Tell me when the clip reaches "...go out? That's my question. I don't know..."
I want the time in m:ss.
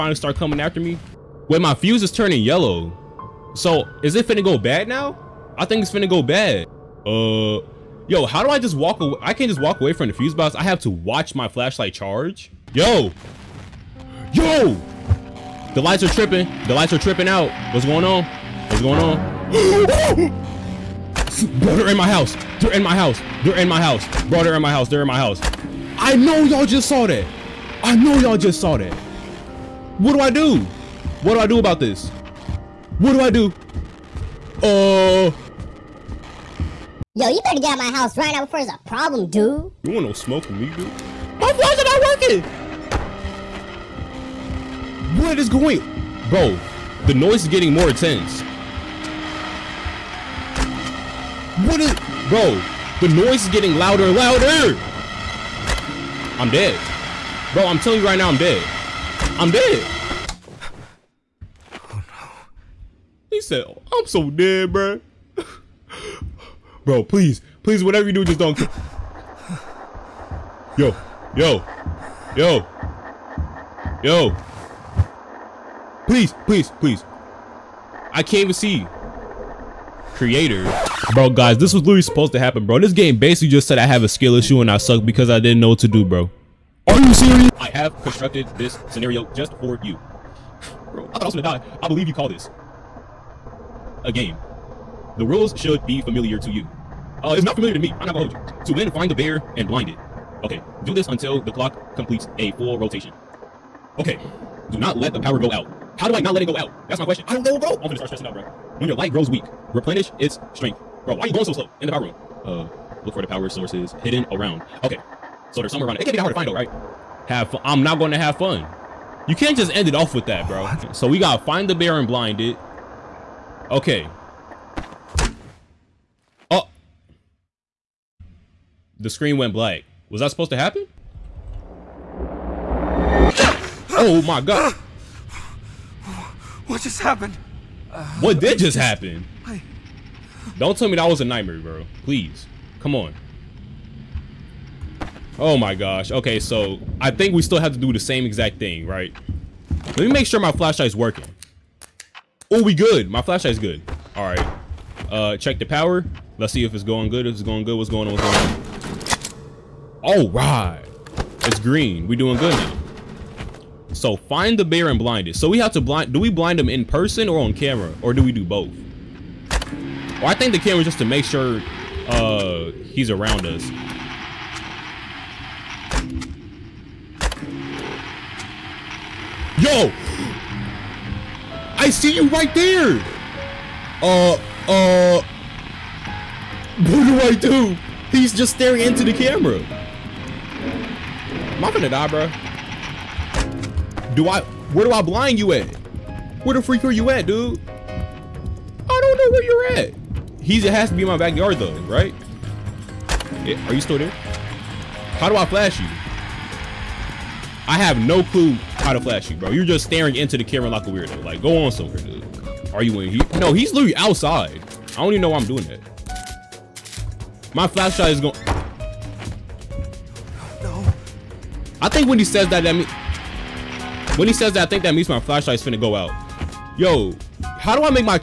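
1:46.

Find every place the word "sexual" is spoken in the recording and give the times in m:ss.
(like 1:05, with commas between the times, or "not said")
not said.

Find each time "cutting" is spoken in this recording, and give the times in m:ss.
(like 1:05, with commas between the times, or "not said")
not said.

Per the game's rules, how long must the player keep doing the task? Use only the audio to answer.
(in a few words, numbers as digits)
a full rotation.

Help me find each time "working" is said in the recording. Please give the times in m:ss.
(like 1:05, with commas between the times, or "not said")
0:42, 2:30.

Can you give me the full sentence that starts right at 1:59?
You can't just end it off with that, bro.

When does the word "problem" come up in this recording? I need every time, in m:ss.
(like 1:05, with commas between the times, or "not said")
0:38.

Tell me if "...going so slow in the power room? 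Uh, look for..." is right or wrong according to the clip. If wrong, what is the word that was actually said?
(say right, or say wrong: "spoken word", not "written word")
right.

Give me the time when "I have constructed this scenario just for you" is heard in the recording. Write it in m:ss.
1:27.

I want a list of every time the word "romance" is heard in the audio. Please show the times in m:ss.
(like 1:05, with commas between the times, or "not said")
not said.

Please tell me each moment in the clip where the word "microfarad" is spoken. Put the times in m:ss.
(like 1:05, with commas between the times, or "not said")
not said.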